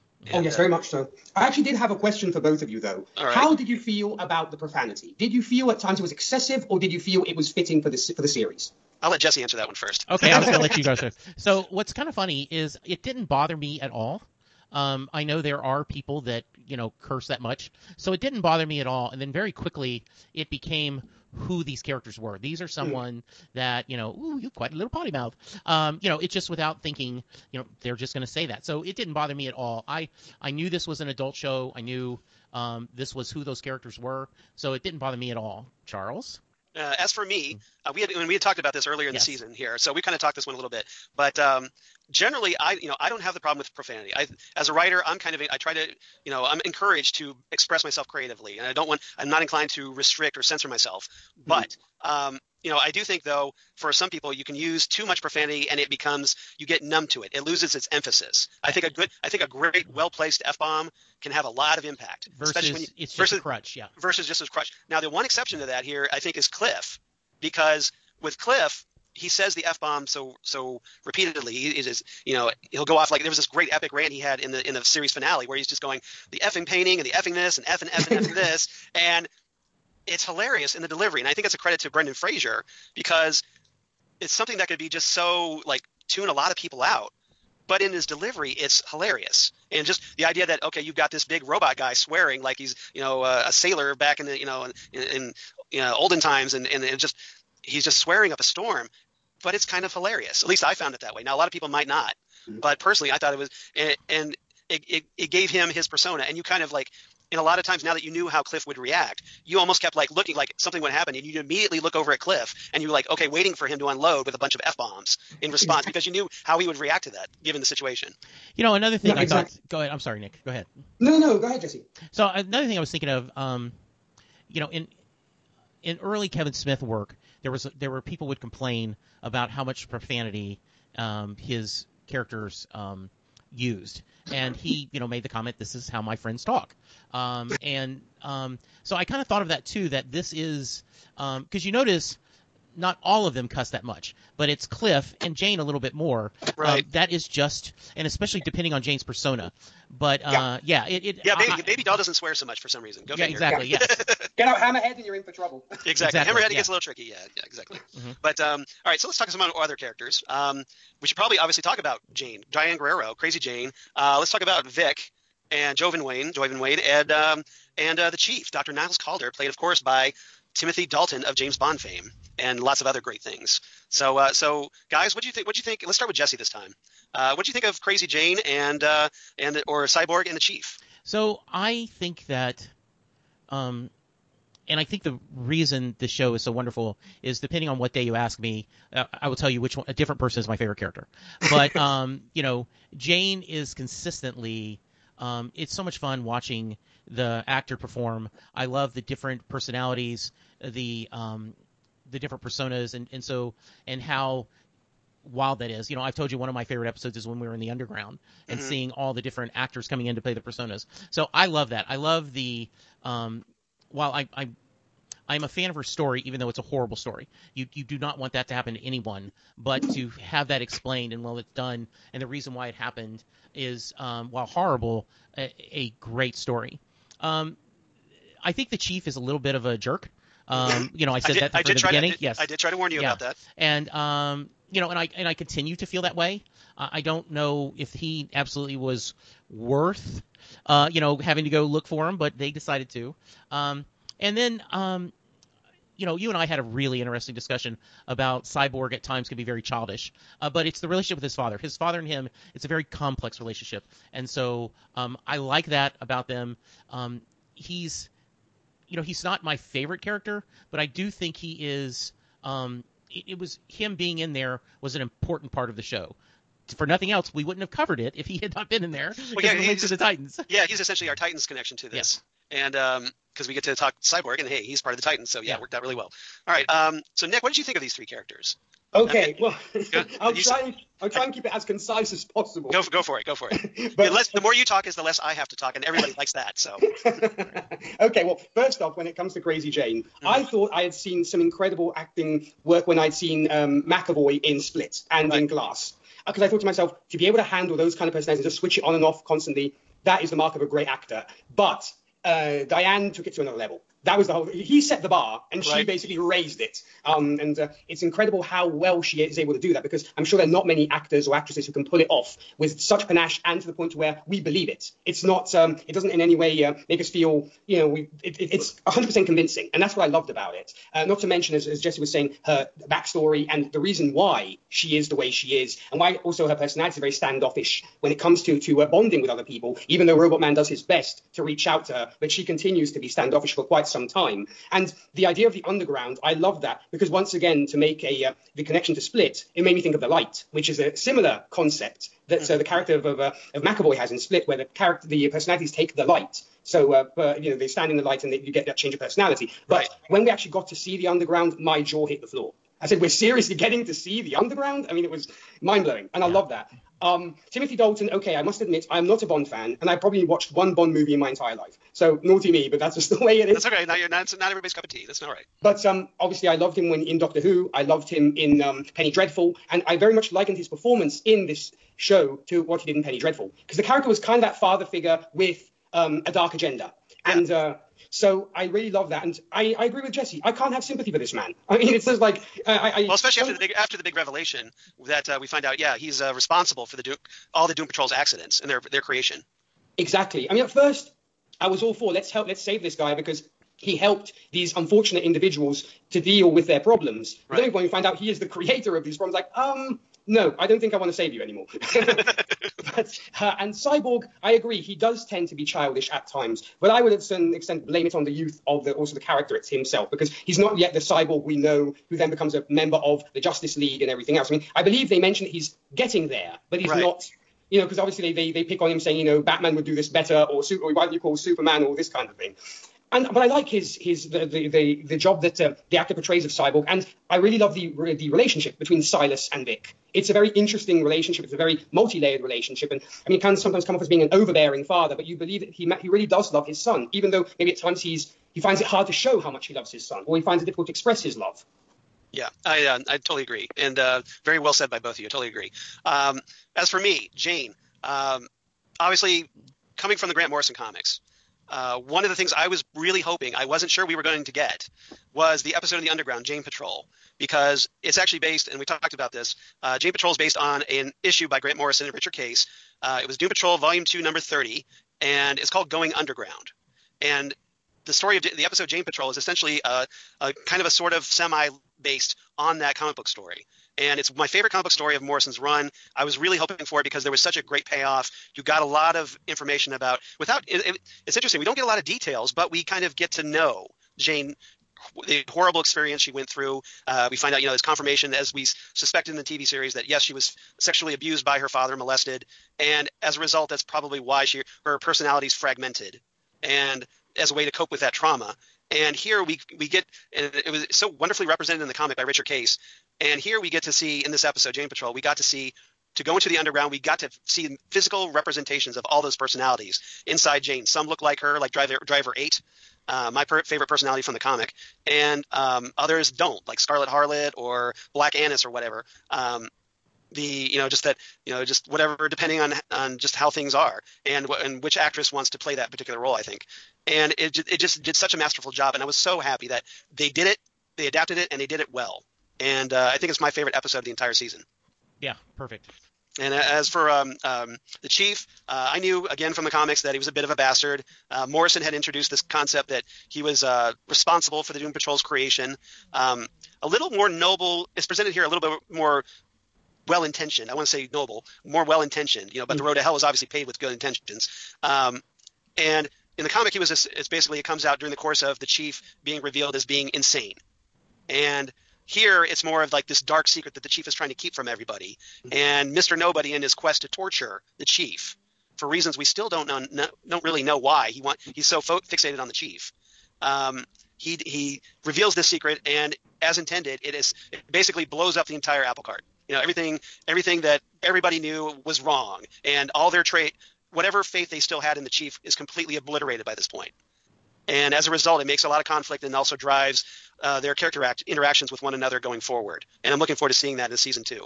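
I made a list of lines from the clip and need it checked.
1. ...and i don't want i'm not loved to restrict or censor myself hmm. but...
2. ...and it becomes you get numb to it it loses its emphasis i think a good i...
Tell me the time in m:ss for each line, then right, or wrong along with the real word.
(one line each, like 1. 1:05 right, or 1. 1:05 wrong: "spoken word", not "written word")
1. 0:48 wrong: "inclined", not "loved"
2. 0:55 right.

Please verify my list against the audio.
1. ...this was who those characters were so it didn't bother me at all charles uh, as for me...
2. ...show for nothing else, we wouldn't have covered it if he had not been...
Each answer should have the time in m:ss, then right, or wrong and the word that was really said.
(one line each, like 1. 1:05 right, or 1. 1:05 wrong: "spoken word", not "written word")
1. 0:32 right
2. 4:25 right.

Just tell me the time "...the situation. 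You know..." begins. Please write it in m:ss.
1:57.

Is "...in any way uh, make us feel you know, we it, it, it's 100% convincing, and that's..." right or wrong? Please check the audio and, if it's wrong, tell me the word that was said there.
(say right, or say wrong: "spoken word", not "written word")
right.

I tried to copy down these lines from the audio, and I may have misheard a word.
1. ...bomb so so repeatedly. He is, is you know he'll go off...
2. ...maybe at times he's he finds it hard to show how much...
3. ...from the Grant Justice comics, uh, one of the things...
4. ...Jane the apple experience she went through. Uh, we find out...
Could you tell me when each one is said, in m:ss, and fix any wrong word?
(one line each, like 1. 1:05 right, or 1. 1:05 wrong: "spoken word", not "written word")
1. 1:09 right
2. 7:17 right
3. 7:30 wrong: "Morrison", not "Justice"
4. 8:04 wrong: "horrible", not "apple".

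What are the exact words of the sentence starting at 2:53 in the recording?
So, uh, so guys, what do you think?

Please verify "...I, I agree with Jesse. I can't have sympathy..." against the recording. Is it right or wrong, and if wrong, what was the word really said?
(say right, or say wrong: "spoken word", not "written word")
right.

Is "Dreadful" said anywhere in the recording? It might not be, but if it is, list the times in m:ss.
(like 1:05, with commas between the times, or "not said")
6:09, 6:13.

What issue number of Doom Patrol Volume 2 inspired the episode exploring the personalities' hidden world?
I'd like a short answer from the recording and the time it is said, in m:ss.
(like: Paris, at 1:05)
30, at 7:44.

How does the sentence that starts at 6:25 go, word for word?
Yeah, he's uh, responsible for the all the Doom Patrol's accidents and their their creation.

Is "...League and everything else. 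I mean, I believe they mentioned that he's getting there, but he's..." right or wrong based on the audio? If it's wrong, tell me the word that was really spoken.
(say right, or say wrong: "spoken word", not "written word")
right.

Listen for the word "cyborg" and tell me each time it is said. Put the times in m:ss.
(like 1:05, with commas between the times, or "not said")
2:59, 4:08, 4:34, 6:43, 6:50, 7:06.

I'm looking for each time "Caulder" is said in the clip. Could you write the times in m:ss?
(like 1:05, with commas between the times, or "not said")
2:48.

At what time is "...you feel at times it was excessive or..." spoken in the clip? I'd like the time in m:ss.
0:05.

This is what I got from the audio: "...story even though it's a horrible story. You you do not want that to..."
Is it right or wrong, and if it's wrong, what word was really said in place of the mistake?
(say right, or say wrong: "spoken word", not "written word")
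right.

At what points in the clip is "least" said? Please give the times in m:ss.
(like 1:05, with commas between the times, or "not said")
1:40.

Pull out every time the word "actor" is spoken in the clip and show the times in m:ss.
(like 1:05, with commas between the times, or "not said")
3:17, 3:29, 5:00, 5:10, 7:05.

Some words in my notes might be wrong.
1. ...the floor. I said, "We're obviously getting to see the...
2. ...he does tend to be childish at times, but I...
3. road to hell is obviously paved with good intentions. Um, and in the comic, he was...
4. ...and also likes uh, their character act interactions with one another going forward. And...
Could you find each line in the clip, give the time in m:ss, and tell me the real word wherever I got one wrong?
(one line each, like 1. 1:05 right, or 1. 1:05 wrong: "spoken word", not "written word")
1. 5:52 wrong: "seriously", not "obviously"
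2. 6:44 right
3. 9:12 right
4. 9:49 wrong: "drives", not "likes".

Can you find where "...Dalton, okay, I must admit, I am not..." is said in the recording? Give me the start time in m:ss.
5:57.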